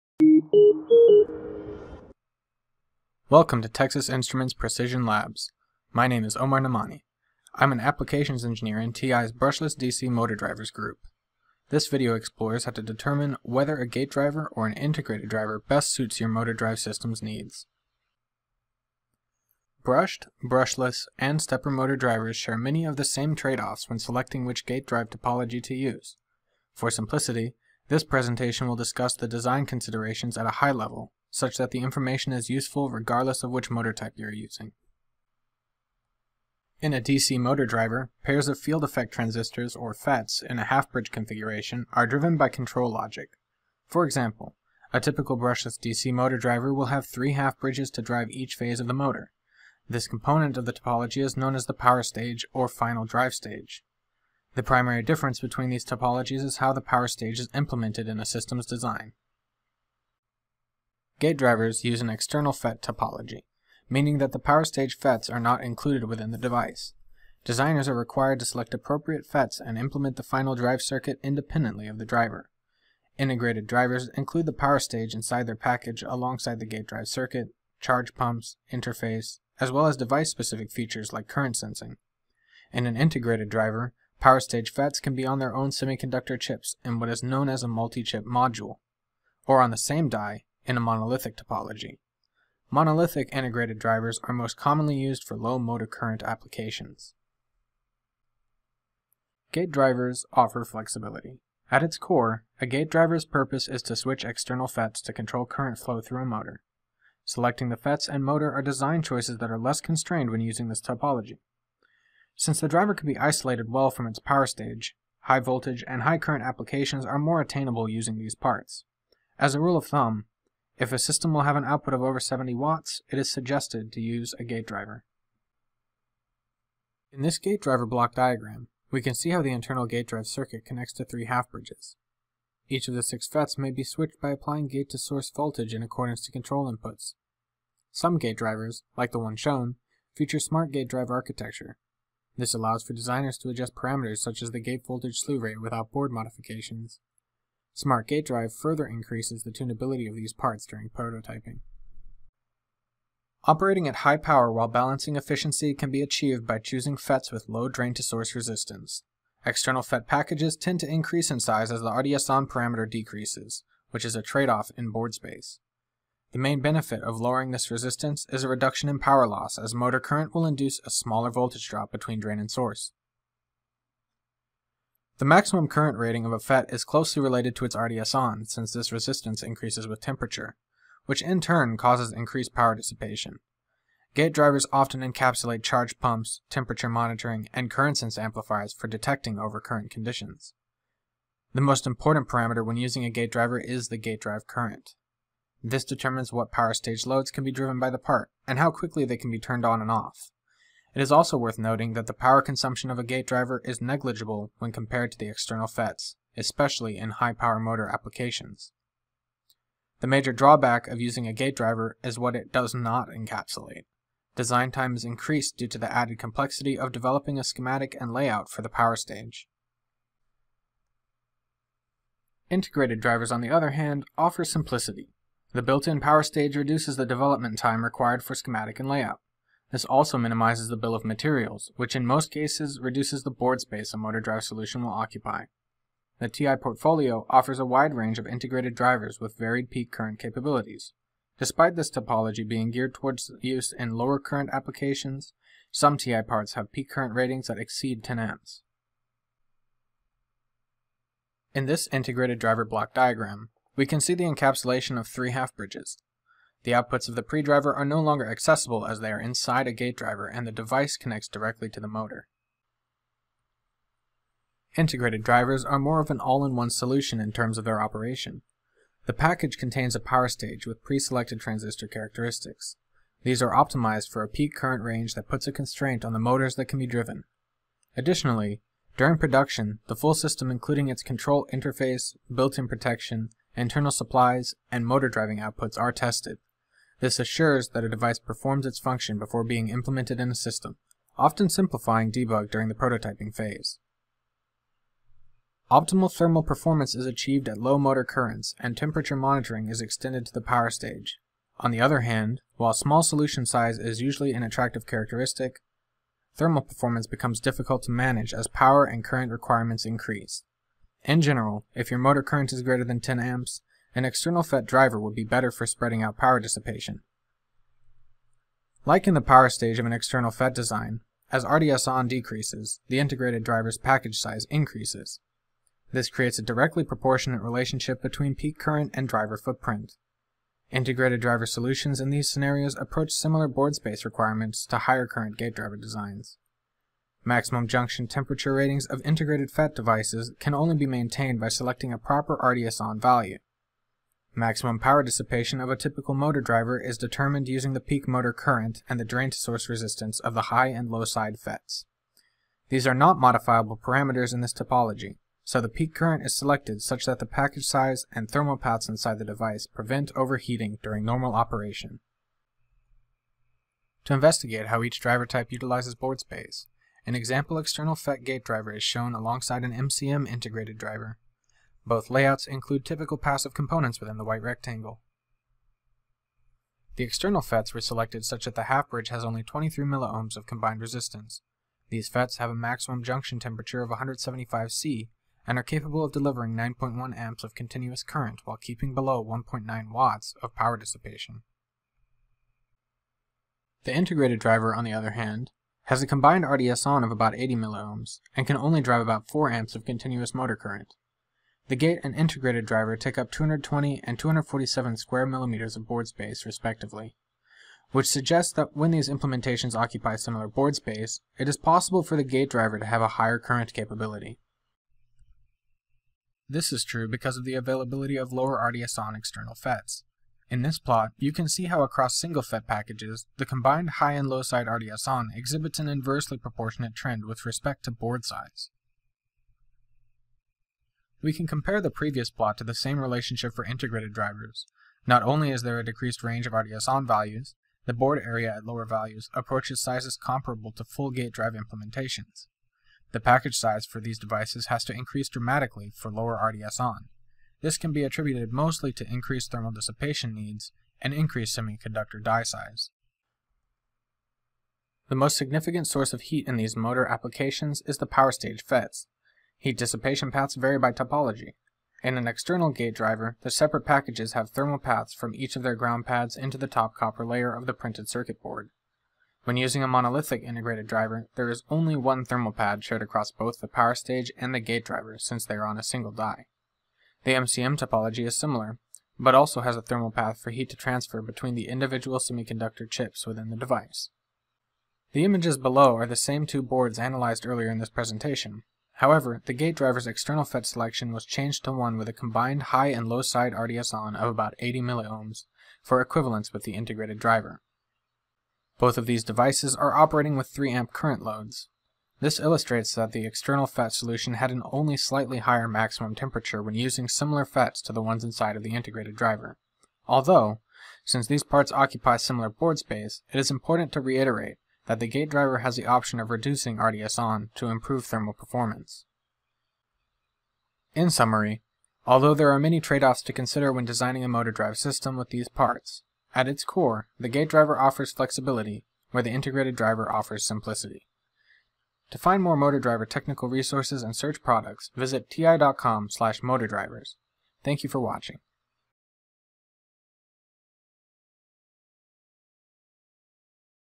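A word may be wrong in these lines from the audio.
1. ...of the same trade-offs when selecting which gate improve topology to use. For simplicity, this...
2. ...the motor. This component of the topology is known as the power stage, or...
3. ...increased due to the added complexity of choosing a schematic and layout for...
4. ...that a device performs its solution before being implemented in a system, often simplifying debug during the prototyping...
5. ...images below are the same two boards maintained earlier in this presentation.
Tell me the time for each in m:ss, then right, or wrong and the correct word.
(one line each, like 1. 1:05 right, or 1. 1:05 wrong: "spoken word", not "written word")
1. 0:22 wrong: "drive", not "improve"
2. 0:48 right
3. 3:35 wrong: "developing", not "choosing"
4. 4:47 wrong: "function", not "solution"
5. 8:05 wrong: "analyzed", not "maintained".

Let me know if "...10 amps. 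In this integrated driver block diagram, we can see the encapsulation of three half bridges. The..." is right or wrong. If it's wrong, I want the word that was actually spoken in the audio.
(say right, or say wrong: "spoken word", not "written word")
right.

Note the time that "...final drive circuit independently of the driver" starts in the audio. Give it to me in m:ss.
1:10.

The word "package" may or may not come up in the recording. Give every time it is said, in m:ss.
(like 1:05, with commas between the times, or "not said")
1:15, 2:40, 4:29, 5:23, 5:57, 7:02, 7:23, 7:43.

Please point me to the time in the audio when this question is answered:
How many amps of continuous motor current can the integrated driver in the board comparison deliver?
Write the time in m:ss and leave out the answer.
6:39.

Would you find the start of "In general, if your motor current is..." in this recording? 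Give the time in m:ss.
5:11.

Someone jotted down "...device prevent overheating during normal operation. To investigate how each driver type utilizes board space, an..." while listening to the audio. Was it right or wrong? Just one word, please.
right.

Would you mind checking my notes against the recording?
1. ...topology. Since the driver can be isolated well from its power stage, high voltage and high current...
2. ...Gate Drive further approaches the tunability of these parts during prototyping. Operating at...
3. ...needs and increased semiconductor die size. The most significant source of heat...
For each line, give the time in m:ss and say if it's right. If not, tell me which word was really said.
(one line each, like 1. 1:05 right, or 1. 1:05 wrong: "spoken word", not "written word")
1. 1:50 right
2. 2:28 wrong: "increases", not "approaches"
3. 7:30 right.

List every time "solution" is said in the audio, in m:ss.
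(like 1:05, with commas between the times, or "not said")
3:54, 4:26, 5:03, 5:31, 8:23.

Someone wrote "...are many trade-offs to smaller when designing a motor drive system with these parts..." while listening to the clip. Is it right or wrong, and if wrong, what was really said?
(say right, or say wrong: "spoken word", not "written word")
wrong: "consider", not "smaller".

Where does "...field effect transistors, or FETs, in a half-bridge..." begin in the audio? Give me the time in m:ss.
0:38.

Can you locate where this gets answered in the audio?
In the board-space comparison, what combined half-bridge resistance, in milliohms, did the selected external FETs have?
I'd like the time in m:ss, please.
6:19.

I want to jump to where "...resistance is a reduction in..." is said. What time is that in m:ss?
2:47.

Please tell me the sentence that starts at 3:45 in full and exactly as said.
The built-in power stage reduces the development time required for schematic and layout.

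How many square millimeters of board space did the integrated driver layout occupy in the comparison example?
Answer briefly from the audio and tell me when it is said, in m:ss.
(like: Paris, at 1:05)
247, at 6:44.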